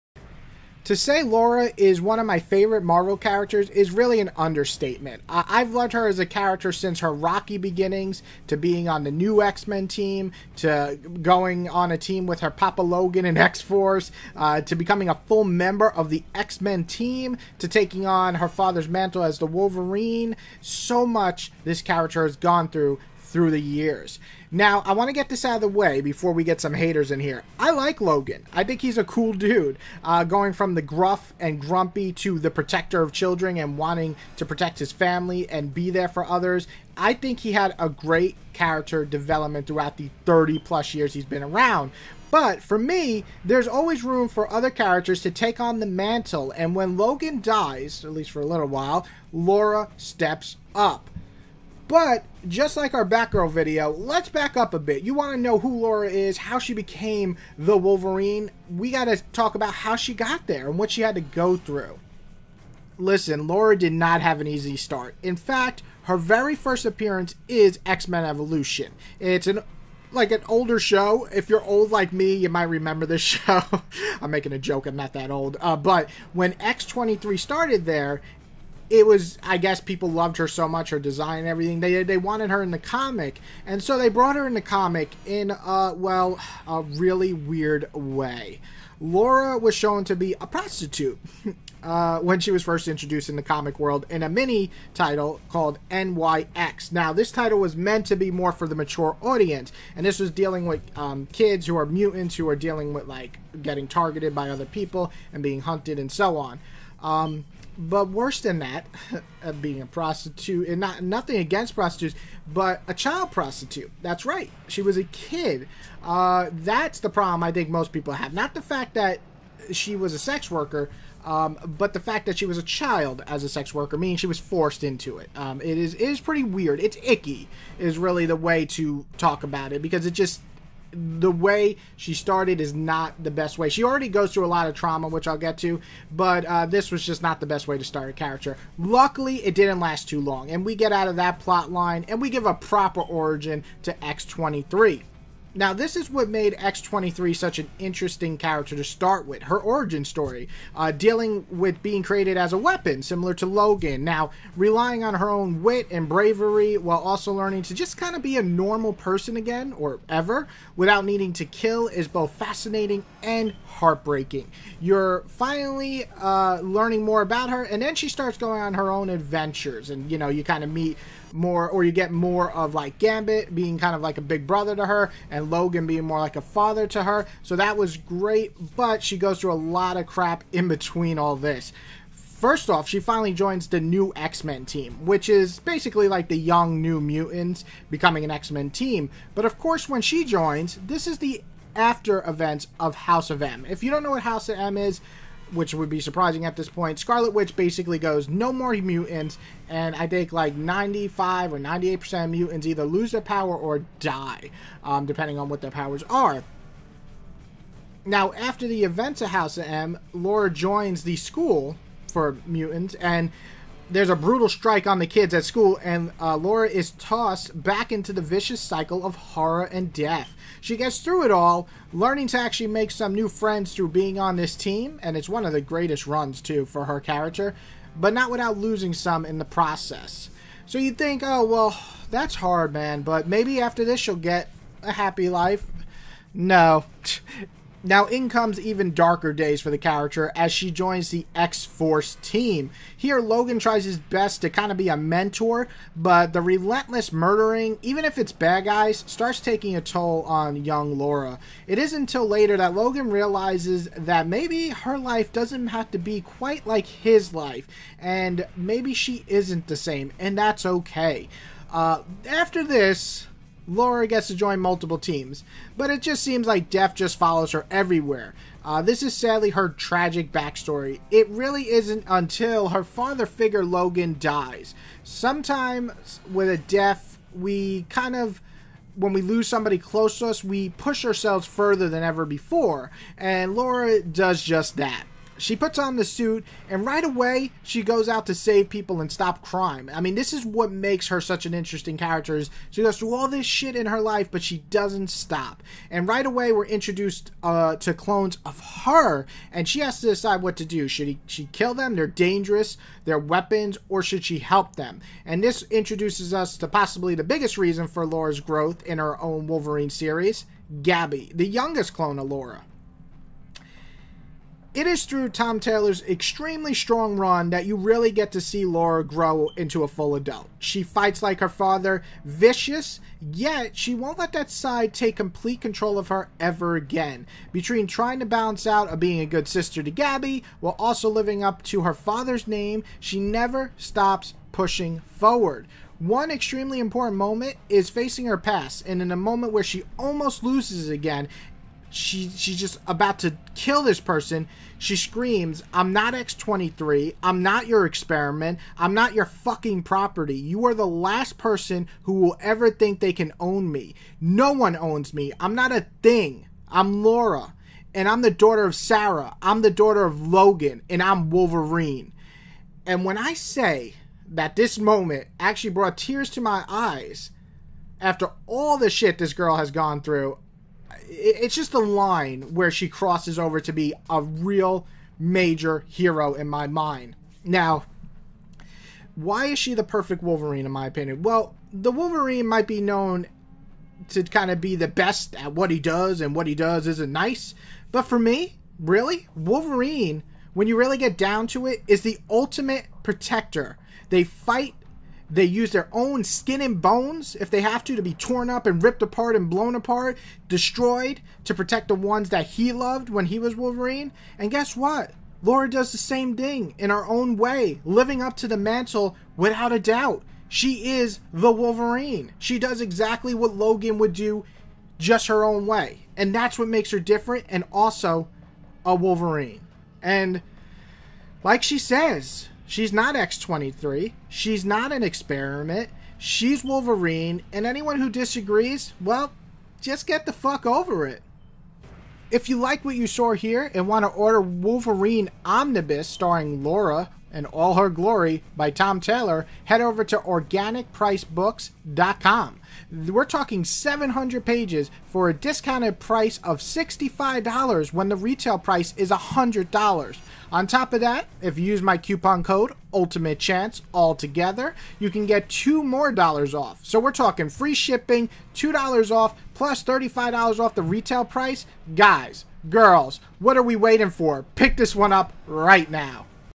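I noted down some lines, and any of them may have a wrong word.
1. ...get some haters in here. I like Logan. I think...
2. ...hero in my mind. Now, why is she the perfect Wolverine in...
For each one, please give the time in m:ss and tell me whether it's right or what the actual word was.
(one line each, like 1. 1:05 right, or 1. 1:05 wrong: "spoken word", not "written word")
1. 0:26 right
2. 6:15 right.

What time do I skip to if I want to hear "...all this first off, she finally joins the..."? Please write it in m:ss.
3:01.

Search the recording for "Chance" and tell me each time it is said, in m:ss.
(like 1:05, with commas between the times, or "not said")
7:33.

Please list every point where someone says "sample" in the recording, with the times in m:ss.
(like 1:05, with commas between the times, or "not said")
not said.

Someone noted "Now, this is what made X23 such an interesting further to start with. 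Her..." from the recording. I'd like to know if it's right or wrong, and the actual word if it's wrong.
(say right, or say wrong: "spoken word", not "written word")
wrong: "character", not "further".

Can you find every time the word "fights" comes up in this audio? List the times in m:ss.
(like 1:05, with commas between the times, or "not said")
5:20, 6:34.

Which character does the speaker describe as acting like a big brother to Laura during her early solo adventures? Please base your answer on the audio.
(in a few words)
Gambit.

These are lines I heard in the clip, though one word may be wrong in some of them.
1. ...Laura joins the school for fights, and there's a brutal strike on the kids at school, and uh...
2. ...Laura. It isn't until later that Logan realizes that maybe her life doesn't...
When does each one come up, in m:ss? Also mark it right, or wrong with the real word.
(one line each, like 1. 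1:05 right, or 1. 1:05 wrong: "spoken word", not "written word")
1. 3:30 wrong: "mutants", not "fights"
2. 4:10 right.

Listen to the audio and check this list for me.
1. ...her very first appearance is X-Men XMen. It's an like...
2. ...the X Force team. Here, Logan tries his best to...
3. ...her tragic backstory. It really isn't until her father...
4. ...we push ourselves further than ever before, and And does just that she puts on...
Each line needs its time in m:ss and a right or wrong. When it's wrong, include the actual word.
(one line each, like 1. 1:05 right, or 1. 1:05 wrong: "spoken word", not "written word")
1. 1:06 wrong: "Evolution", not "XMen"
2. 4:01 right
3. 4:29 right
4. 4:40 wrong: "Laura", not "And".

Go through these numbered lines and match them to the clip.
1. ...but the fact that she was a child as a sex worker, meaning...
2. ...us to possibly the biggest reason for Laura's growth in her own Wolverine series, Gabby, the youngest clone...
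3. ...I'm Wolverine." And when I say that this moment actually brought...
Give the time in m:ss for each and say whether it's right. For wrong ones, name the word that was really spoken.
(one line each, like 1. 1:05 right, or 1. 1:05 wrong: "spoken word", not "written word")
1. 2:01 right
2. 5:06 right
3. 6:01 right.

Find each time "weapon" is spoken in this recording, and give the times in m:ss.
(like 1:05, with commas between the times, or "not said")
2:32, 5:03.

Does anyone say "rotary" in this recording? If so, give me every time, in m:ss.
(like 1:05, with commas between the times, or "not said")
not said.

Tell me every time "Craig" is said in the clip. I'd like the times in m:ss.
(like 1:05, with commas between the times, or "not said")
not said.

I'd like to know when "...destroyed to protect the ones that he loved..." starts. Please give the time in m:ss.
6:40.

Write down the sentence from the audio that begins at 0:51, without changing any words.
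But just like our Batgirl video, let's back up a bit.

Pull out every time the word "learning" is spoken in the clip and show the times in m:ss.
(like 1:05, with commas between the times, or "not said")
2:37, 2:46, 3:41.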